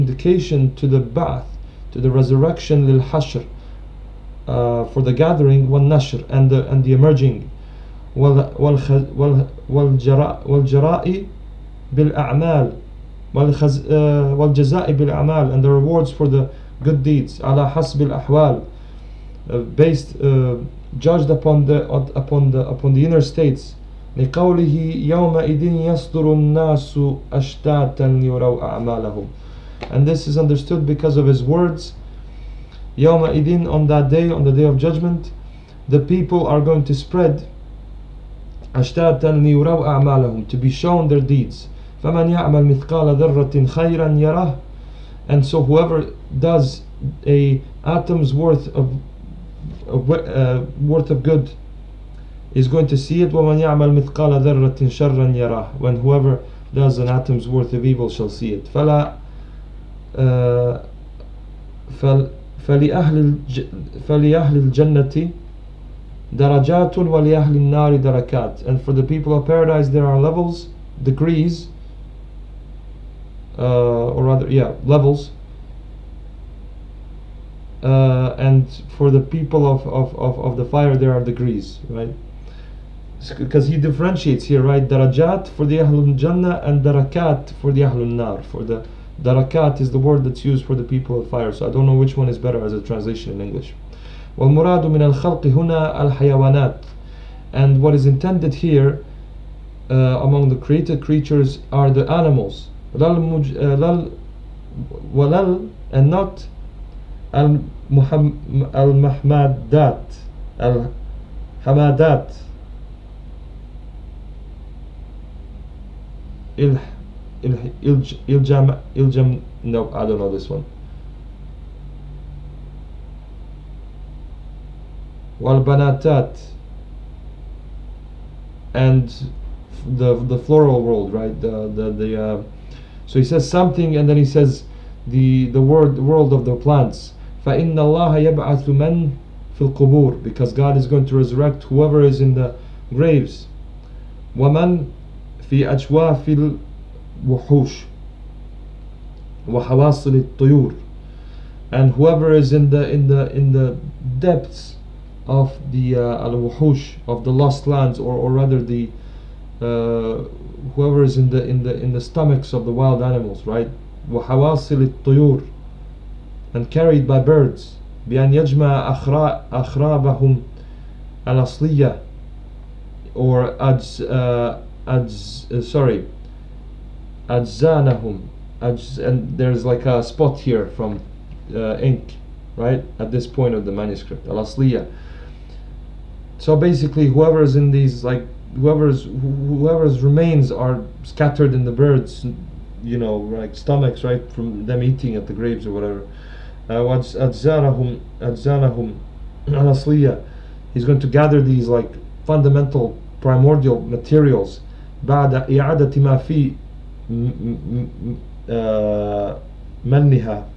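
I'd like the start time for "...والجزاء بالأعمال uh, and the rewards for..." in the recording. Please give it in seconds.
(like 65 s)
13 s.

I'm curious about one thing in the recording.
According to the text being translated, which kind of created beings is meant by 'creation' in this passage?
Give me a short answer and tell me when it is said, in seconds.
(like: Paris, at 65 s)
the animals, at 101 s.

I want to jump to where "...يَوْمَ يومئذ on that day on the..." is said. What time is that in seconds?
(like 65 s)
32 s.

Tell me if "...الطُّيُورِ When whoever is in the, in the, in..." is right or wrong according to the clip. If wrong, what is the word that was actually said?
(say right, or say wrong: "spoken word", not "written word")
wrong: "And", not "When".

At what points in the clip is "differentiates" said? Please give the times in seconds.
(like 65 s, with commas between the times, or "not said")
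83 s.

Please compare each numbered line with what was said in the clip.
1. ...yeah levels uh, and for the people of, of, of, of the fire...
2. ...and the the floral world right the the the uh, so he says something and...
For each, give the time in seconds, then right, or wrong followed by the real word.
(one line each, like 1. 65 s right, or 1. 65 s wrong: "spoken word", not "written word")
1. 74 s right
2. 128 s right.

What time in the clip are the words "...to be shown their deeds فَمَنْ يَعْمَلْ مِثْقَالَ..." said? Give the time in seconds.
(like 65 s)
40 s.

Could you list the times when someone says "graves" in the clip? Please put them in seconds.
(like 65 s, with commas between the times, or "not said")
142 s, 195 s.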